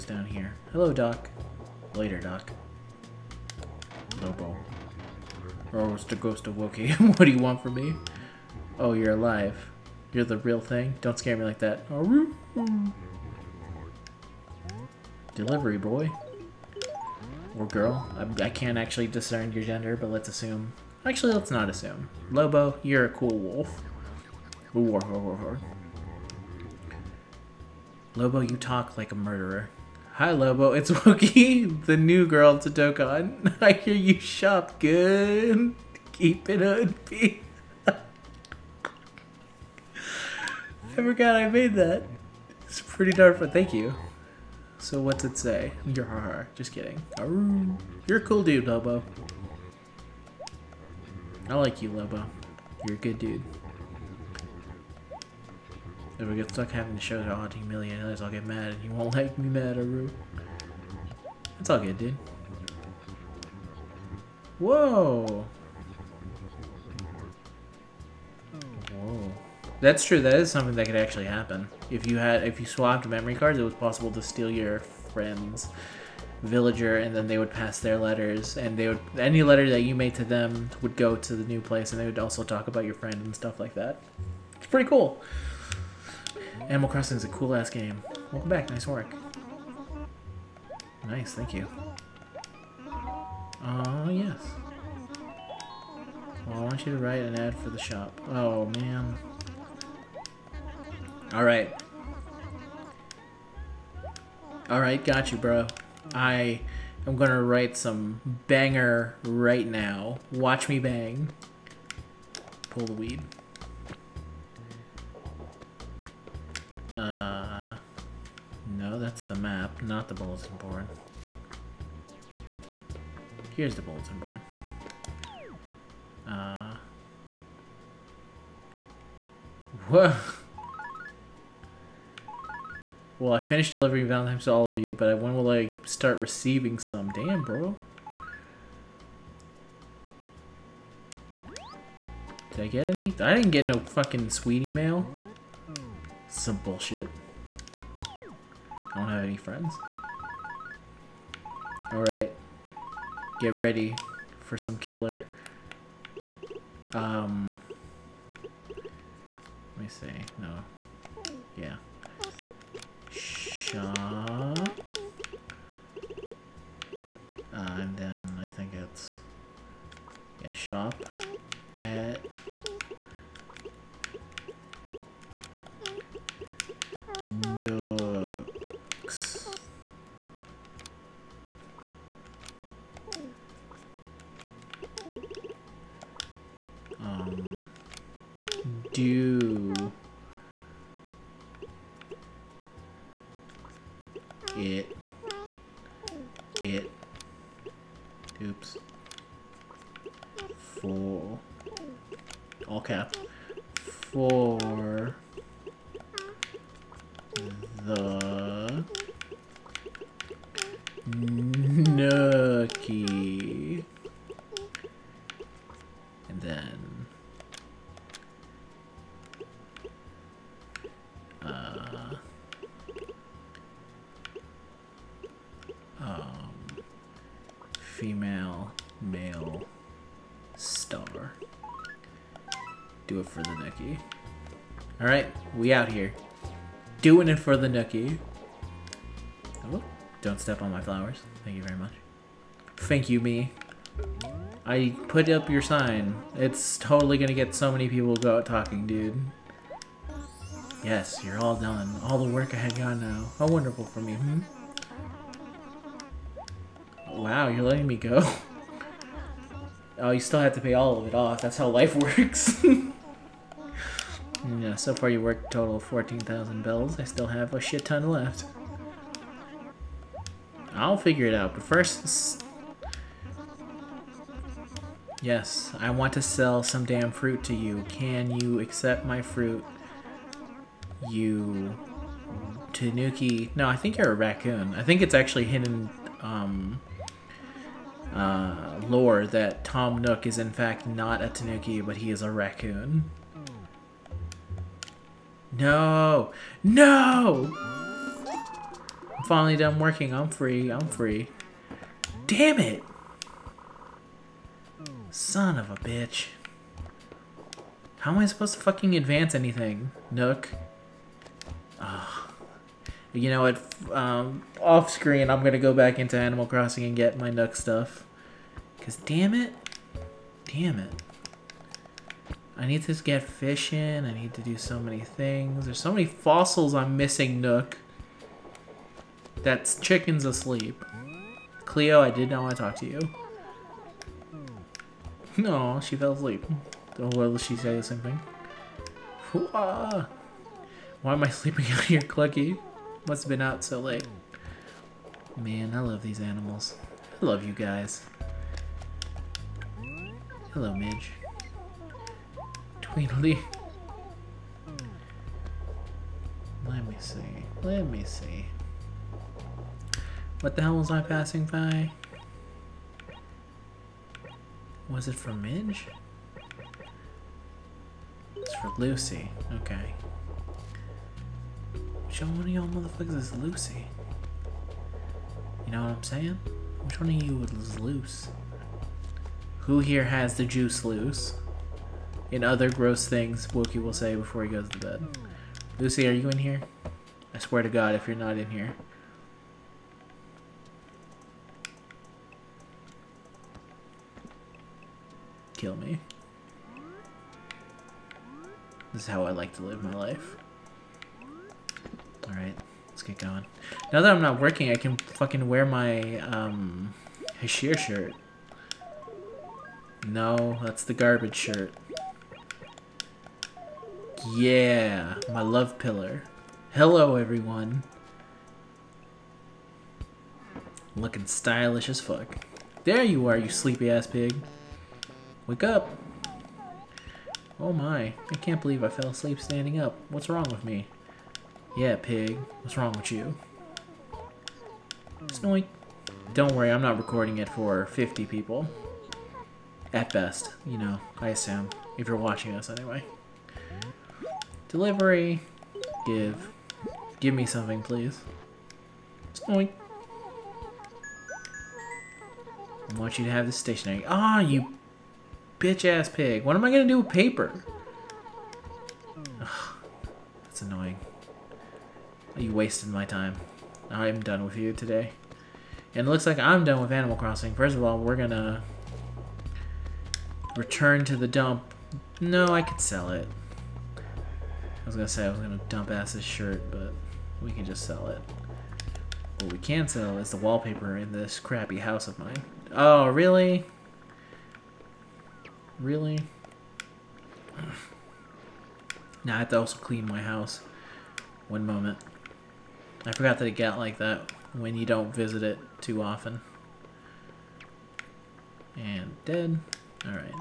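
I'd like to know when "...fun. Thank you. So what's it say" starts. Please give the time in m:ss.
0:43.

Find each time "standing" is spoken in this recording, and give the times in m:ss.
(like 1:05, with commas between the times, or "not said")
7:09.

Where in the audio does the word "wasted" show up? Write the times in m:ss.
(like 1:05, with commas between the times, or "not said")
7:42.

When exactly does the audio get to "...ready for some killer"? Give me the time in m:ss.
2:33.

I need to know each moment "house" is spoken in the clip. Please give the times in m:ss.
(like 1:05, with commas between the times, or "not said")
8:01, 8:10.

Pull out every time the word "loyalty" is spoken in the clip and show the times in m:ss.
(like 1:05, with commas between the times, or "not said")
not said.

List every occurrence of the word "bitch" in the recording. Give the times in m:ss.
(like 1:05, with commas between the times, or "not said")
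5:05, 7:35.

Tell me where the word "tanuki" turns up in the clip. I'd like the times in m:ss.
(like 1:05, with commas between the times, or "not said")
4:42, 4:51.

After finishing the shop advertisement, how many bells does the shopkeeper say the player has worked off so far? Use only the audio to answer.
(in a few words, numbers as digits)
14,000 bells.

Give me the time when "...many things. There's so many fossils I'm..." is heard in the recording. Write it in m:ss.
5:24.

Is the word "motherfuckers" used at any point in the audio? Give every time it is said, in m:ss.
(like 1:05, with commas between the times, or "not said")
6:12.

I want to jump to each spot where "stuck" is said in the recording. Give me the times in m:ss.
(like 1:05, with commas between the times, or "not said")
0:56.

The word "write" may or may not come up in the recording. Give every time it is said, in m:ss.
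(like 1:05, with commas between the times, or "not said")
1:36, 1:47.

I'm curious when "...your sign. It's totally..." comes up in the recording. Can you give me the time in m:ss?
4:05.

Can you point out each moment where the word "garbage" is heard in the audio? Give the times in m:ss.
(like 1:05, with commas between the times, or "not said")
6:50.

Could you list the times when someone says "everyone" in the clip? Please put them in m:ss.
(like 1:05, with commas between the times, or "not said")
6:57.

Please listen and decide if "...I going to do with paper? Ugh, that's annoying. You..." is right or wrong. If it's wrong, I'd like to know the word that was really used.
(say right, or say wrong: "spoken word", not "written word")
right.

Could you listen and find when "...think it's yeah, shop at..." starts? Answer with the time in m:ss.
2:48.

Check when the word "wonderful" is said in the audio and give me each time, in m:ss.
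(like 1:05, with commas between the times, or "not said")
4:13.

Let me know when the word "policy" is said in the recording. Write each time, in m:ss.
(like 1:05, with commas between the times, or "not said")
not said.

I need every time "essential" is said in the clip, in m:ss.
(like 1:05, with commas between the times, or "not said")
not said.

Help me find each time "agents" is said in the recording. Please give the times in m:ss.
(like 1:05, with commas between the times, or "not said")
not said.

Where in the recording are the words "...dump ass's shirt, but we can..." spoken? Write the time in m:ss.
7:55.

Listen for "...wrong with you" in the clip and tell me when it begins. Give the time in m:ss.
7:12.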